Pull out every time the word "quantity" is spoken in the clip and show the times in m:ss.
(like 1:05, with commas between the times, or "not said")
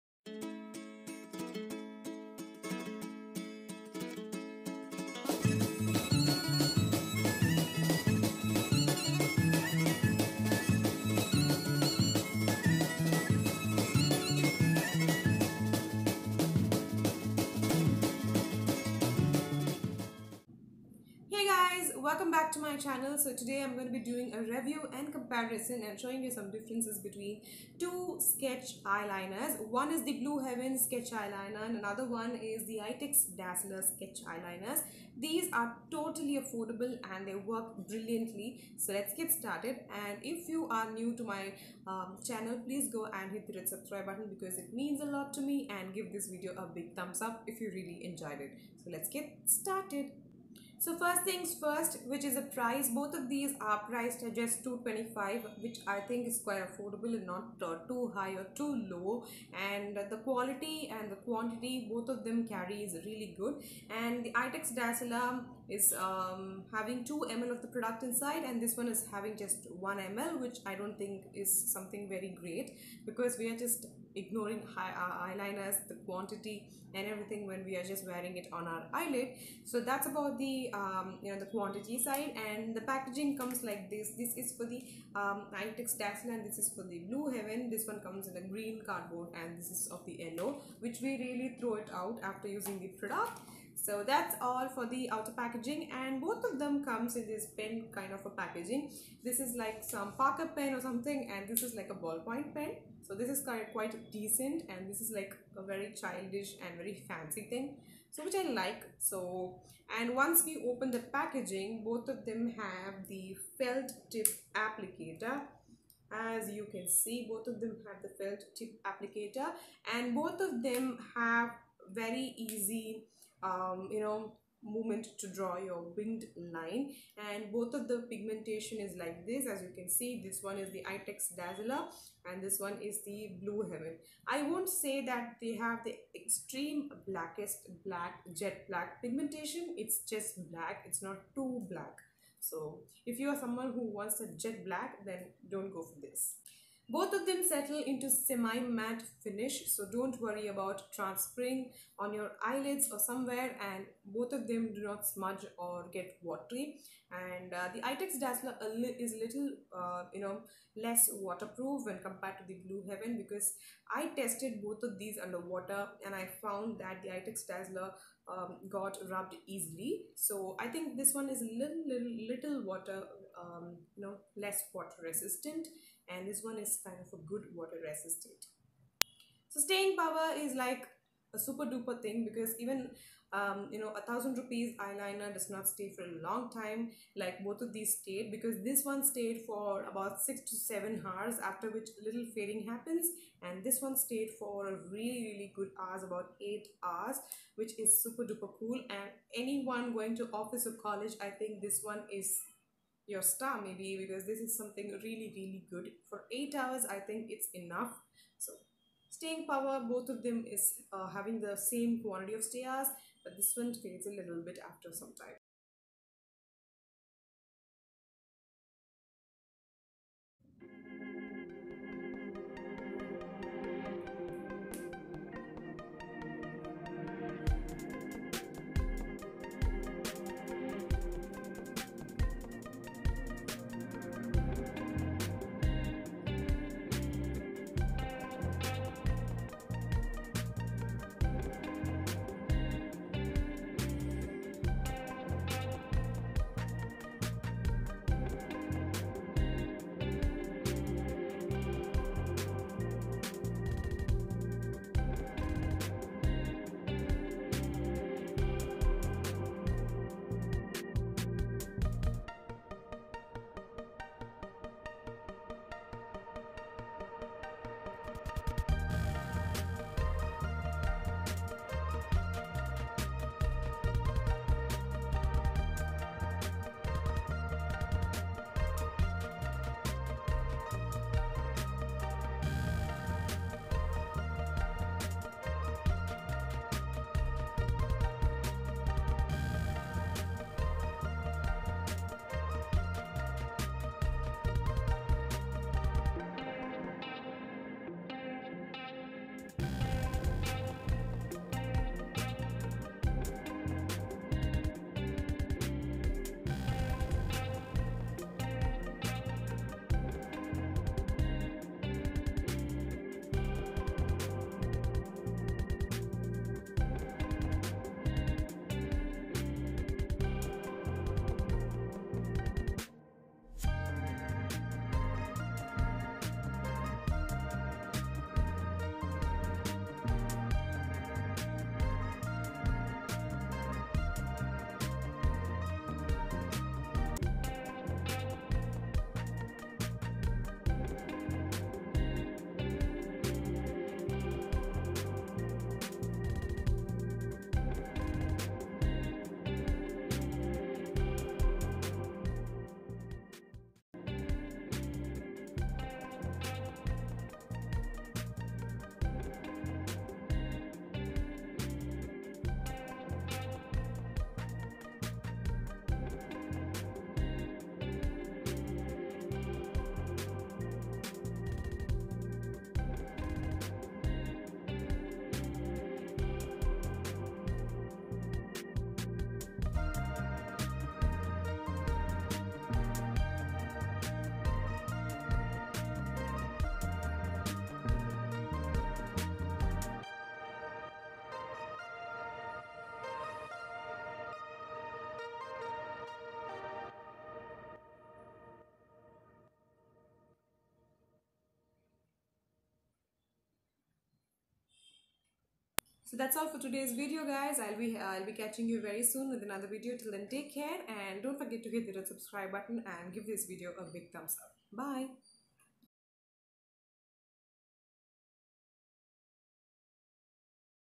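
1:01, 1:16, 1:21, 3:32.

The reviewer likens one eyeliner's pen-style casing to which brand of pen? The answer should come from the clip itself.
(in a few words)
Parker.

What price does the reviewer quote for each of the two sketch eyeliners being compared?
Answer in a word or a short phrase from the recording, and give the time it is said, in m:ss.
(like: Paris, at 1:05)
225, at 0:54.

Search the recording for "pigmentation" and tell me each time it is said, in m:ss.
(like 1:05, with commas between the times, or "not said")
2:08, 2:19.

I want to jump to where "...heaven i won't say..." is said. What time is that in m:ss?
2:13.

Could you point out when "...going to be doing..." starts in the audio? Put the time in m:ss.
0:23.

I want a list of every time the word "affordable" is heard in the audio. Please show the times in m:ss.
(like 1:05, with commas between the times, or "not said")
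0:36, 0:56.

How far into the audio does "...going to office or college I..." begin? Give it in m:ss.
3:19.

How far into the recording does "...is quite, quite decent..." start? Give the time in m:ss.
1:43.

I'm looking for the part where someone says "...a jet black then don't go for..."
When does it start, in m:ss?
2:24.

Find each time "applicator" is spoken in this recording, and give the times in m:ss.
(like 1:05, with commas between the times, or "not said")
1:54, 1:58.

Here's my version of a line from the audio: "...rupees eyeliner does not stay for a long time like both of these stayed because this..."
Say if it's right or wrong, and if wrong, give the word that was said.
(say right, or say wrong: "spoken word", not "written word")
right.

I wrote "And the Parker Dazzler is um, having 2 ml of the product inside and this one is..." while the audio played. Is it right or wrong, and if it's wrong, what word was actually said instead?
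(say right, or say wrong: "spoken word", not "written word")
wrong: "Eyetex", not "Parker".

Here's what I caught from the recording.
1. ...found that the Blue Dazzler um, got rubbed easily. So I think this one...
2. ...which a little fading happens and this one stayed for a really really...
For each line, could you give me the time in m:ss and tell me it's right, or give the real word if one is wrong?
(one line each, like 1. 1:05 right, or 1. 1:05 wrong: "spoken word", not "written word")
1. 2:46 wrong: "Eyetex", not "Blue"
2. 3:11 right.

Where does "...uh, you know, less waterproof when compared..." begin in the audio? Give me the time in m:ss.
2:39.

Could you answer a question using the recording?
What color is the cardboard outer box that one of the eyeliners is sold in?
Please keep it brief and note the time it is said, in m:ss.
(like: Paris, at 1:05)
Green, at 1:28.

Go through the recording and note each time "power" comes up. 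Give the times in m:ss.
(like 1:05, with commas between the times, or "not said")
2:59, 3:29.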